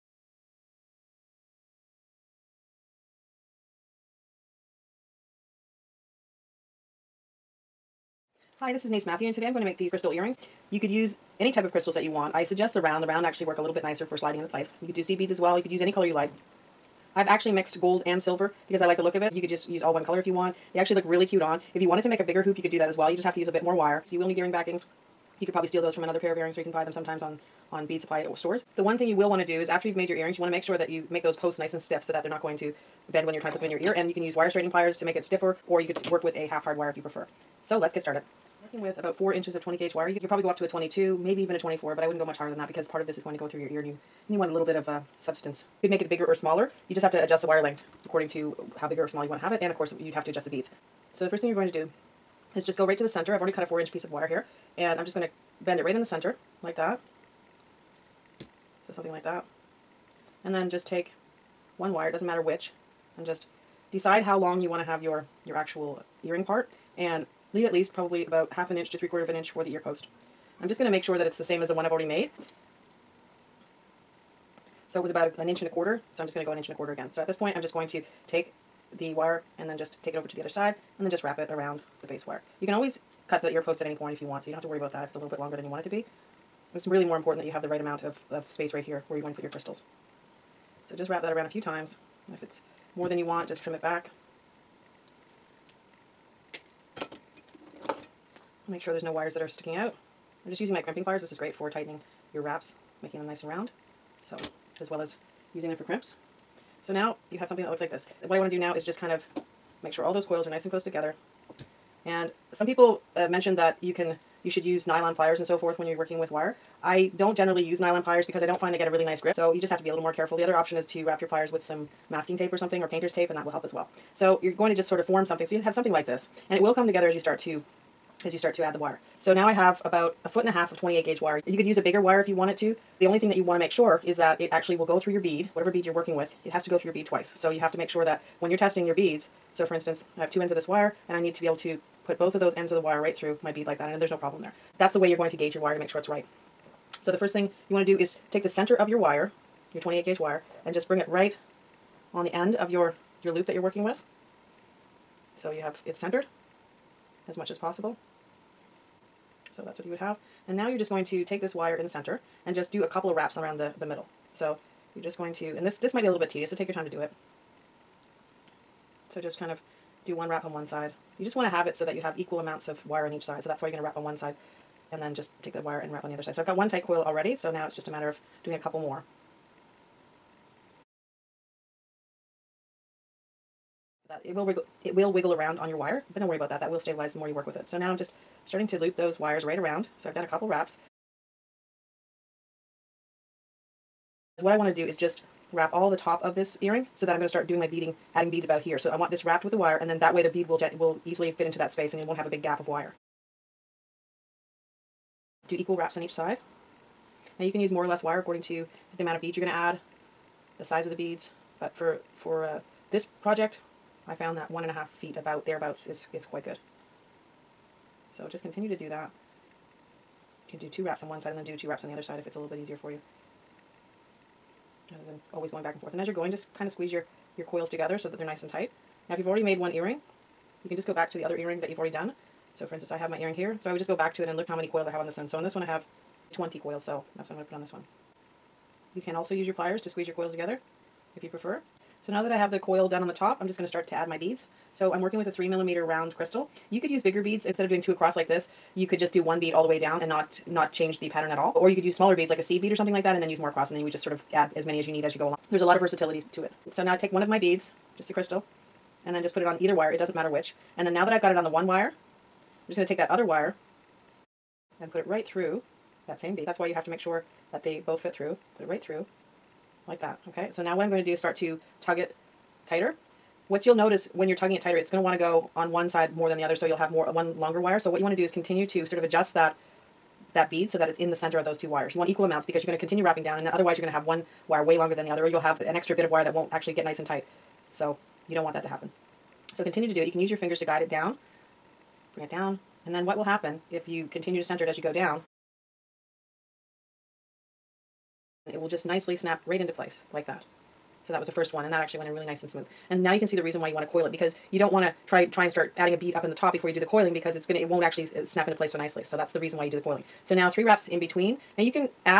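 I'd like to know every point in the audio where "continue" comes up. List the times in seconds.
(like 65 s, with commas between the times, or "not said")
218 s, 278 s, 282 s, 289 s, 294 s.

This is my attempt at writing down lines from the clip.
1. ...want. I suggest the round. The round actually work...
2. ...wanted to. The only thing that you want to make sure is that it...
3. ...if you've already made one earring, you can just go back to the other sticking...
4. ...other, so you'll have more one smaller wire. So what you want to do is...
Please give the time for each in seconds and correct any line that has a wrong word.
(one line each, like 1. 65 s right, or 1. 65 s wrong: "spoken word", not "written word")
1. 12 s right
2. 132 s right
3. 229 s wrong: "earring", not "sticking"
4. 276 s wrong: "longer", not "smaller".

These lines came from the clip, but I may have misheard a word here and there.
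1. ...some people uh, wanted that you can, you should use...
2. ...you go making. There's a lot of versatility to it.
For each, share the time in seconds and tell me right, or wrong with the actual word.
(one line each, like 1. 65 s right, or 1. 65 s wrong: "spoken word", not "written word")
1. 112 s wrong: "mentioned", not "wanted"
2. 255 s wrong: "along", not "making".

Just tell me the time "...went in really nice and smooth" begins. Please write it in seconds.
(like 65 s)
301 s.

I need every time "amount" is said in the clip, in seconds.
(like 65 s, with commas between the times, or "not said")
87 s, 172 s, 209 s, 282 s.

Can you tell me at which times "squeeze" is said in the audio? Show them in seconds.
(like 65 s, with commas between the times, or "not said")
226 s, 239 s.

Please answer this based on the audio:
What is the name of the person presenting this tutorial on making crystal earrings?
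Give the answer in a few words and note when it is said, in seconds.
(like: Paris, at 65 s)
Denise Mathew, at 8 s.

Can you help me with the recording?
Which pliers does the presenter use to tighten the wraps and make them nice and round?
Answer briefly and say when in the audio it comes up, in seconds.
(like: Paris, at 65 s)
crimping pliers, at 100 s.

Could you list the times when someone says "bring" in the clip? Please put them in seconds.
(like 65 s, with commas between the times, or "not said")
150 s, 292 s.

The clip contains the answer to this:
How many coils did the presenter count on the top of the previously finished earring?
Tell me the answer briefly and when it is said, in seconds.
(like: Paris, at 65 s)
20, at 236 s.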